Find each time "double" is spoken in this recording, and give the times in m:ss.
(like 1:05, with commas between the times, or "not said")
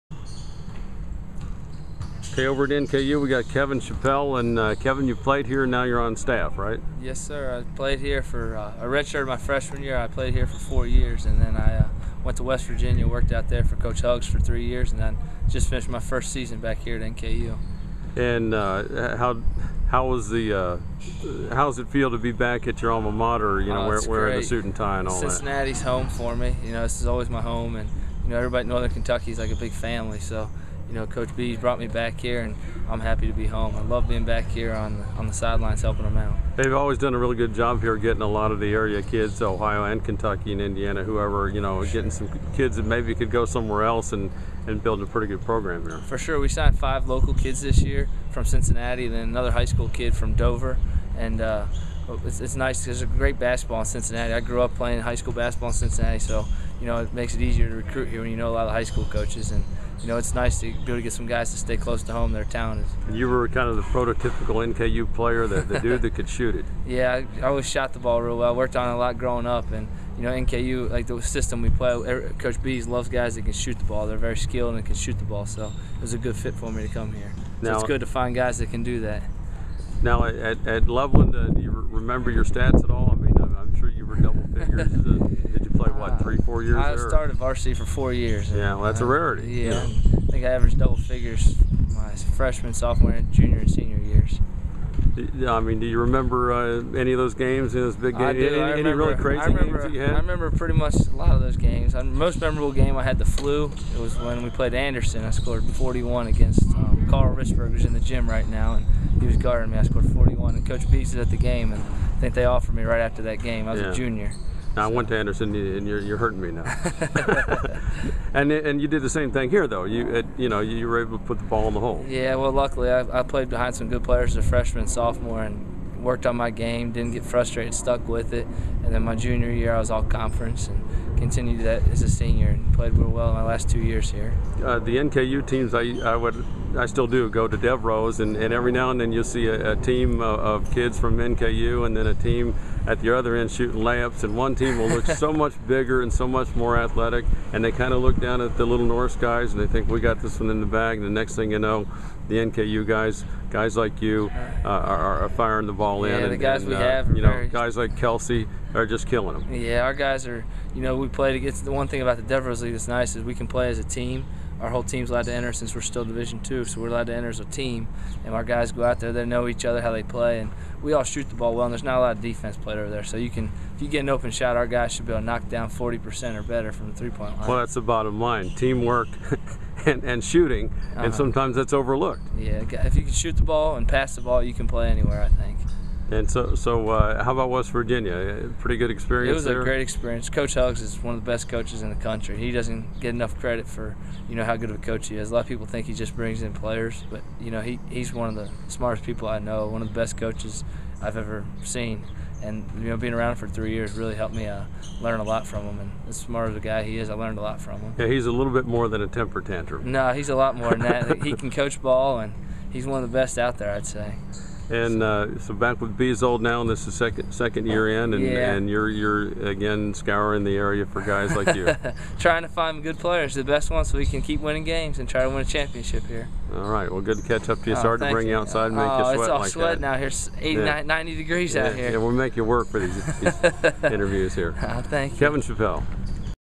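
1:24, 1:30.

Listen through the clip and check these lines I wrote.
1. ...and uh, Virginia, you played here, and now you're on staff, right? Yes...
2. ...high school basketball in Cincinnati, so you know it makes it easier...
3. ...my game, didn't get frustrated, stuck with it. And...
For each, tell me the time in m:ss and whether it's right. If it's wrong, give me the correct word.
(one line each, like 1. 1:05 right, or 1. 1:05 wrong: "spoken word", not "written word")
1. 0:04 wrong: "Kevin", not "Virginia"
2. 0:54 right
3. 2:06 right.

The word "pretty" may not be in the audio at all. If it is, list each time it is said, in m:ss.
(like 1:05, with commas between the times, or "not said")
0:45, 1:40, 3:08.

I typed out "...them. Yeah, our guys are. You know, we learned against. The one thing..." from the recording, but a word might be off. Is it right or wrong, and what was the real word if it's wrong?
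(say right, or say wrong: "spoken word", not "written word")
wrong: "played", not "learned".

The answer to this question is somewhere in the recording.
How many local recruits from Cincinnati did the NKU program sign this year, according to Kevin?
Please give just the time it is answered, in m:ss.
0:46.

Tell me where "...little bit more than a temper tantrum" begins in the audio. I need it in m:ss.
3:28.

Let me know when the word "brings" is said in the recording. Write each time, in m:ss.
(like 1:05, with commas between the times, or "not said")
3:16, 3:48.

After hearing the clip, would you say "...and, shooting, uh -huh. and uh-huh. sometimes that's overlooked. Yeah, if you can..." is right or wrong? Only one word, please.
right.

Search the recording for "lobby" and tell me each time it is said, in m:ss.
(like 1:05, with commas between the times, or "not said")
not said.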